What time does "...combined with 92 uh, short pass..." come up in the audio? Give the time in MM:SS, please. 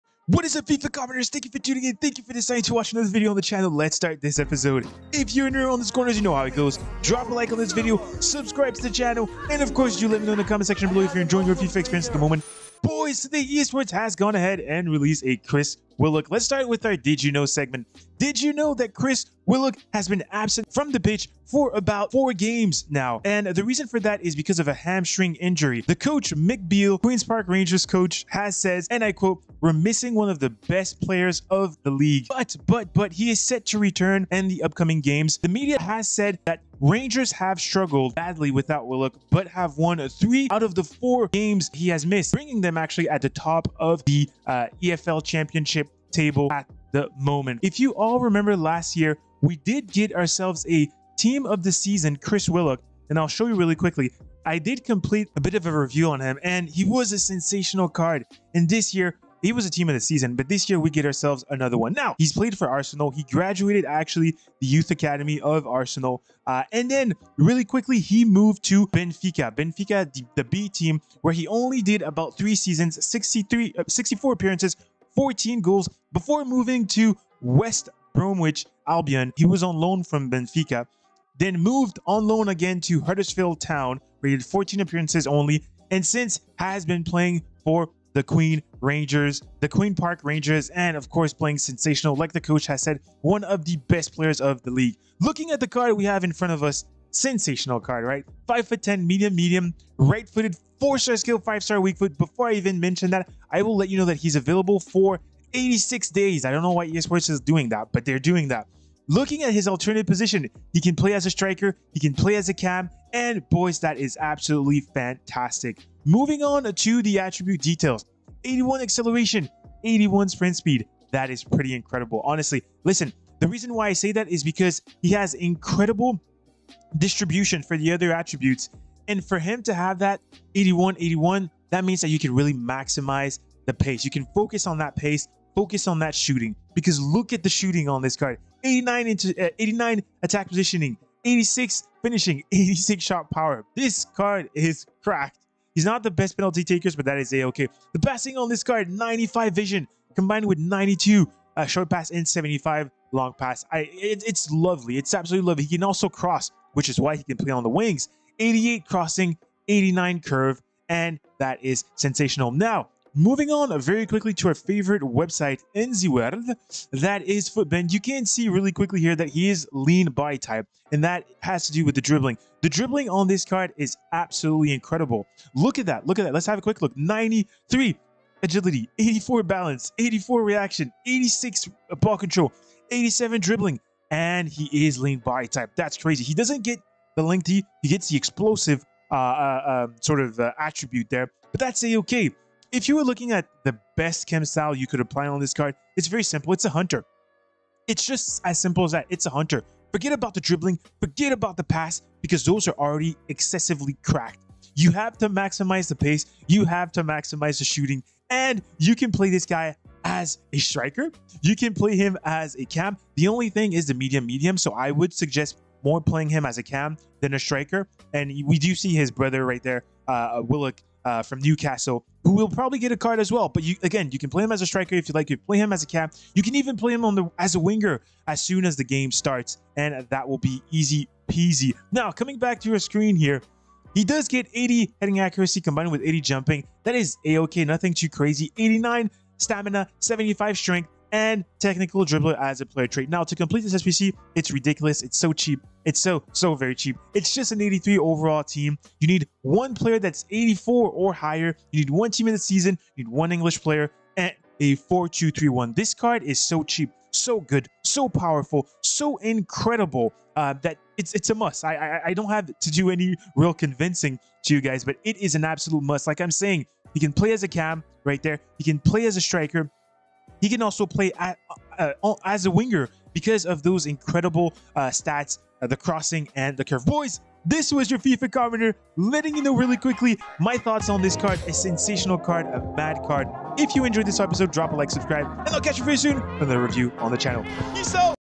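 02:30.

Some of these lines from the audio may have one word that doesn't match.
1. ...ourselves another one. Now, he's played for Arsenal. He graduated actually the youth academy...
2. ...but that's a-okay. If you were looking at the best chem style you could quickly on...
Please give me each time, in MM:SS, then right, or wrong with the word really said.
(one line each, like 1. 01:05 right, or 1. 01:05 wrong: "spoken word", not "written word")
1. 01:01 right
2. 03:11 wrong: "apply", not "quickly".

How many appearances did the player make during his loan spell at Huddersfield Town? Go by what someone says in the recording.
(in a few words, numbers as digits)
14.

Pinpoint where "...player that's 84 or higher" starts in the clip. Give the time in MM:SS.
04:09.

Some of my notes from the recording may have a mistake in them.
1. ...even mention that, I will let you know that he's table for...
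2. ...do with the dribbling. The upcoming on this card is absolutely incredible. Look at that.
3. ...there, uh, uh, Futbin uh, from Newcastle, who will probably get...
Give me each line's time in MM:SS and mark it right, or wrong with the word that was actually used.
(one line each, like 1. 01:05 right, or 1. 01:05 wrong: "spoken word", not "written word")
1. 01:42 wrong: "available", not "table"
2. 02:51 wrong: "dribbling", not "upcoming"
3. 03:39 wrong: "Willock", not "Futbin".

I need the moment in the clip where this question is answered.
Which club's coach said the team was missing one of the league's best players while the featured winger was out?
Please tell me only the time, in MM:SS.
00:26.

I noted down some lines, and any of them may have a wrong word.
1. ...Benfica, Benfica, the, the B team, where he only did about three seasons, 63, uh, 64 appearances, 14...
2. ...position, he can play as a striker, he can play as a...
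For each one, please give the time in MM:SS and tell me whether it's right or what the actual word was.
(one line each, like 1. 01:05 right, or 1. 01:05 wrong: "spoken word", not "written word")
1. 01:08 right
2. 01:50 right.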